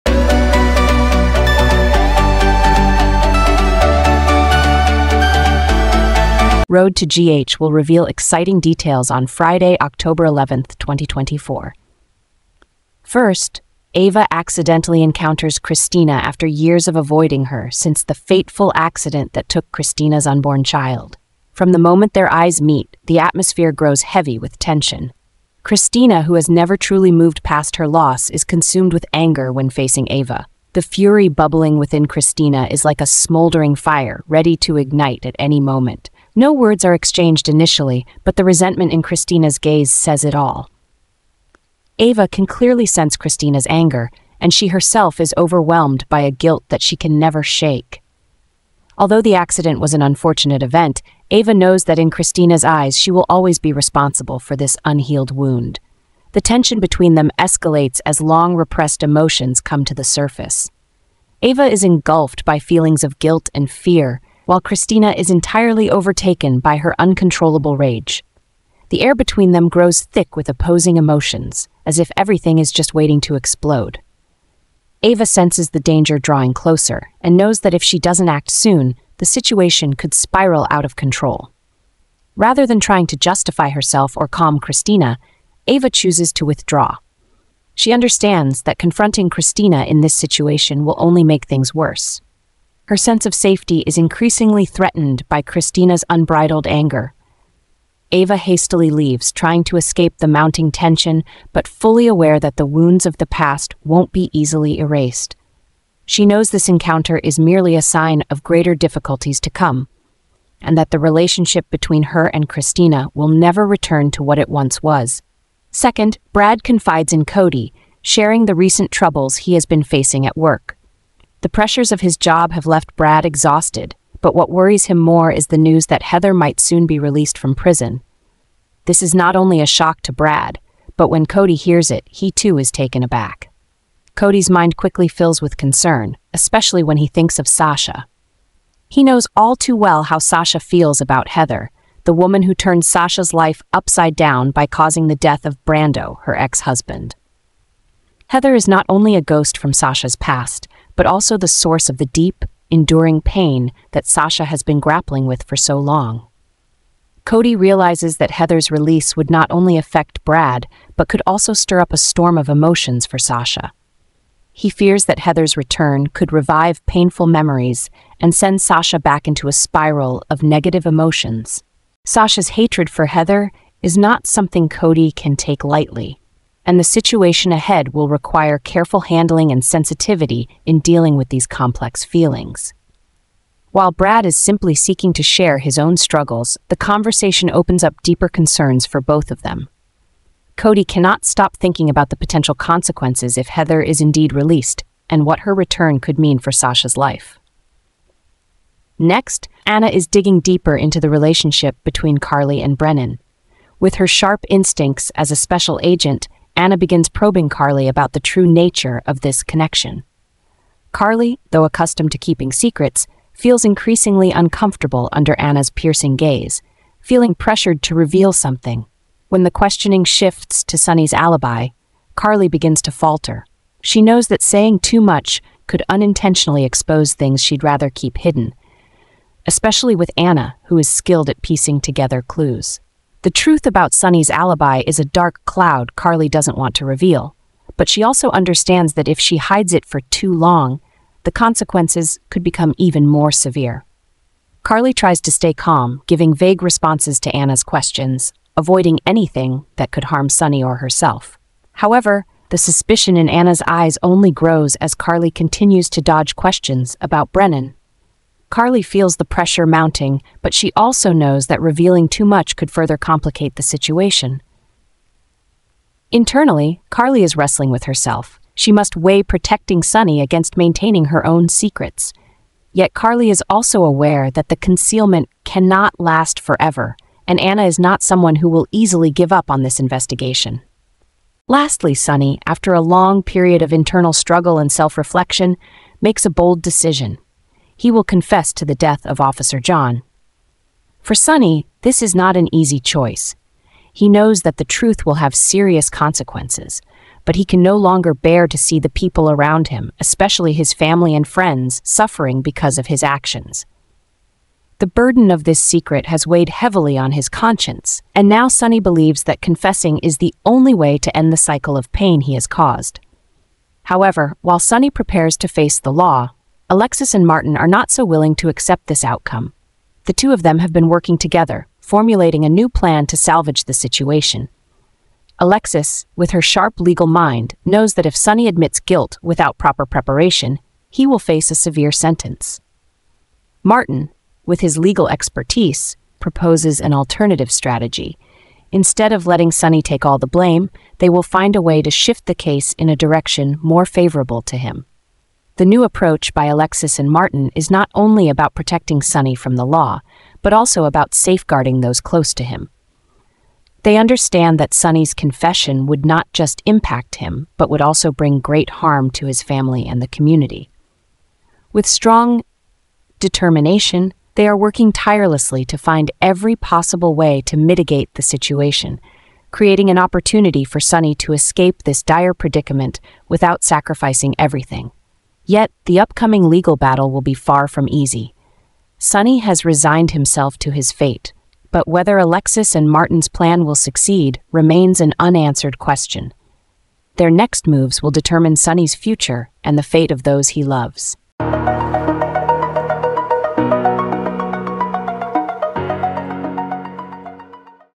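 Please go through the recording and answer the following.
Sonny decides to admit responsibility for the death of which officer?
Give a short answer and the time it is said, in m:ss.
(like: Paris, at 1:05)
Officer John, at 4:49.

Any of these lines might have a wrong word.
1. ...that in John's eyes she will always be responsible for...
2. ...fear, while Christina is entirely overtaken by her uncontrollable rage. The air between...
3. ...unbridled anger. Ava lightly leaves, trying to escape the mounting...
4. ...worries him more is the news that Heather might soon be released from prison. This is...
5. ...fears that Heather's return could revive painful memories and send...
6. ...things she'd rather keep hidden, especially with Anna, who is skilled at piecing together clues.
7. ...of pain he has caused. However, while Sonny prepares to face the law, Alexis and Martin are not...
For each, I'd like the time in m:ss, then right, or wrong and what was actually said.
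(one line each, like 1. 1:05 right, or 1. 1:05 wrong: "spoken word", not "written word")
1. 0:51 wrong: "Christina", not "John"
2. 1:03 right
3. 1:36 wrong: "hastily", not "lightly"
4. 2:04 right
5. 2:44 right
6. 3:47 right
7. 5:11 right.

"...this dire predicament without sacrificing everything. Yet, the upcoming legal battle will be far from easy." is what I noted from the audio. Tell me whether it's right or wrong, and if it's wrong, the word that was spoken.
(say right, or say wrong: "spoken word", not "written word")
right.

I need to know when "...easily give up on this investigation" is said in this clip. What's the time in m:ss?
4:38.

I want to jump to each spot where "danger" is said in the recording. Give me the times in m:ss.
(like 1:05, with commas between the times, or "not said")
1:15.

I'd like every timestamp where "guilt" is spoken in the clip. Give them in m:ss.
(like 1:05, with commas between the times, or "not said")
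0:46, 1:03, 5:28.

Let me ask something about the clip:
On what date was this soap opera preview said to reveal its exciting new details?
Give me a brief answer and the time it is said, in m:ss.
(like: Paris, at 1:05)
Friday, October 11, 2024, at 0:09.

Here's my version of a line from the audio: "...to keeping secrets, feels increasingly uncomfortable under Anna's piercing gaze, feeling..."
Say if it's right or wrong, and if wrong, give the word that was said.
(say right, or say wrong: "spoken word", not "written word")
right.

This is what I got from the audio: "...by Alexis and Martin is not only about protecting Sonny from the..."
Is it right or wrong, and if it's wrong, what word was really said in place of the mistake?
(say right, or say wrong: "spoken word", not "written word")
right.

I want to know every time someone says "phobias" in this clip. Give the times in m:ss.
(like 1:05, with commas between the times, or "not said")
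not said.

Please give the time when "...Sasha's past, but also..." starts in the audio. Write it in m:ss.
2:29.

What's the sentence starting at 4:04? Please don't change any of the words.
Carly tries to stay calm, giving vague responses to Anna's questions, avoiding anything that could harm Sonny or herself.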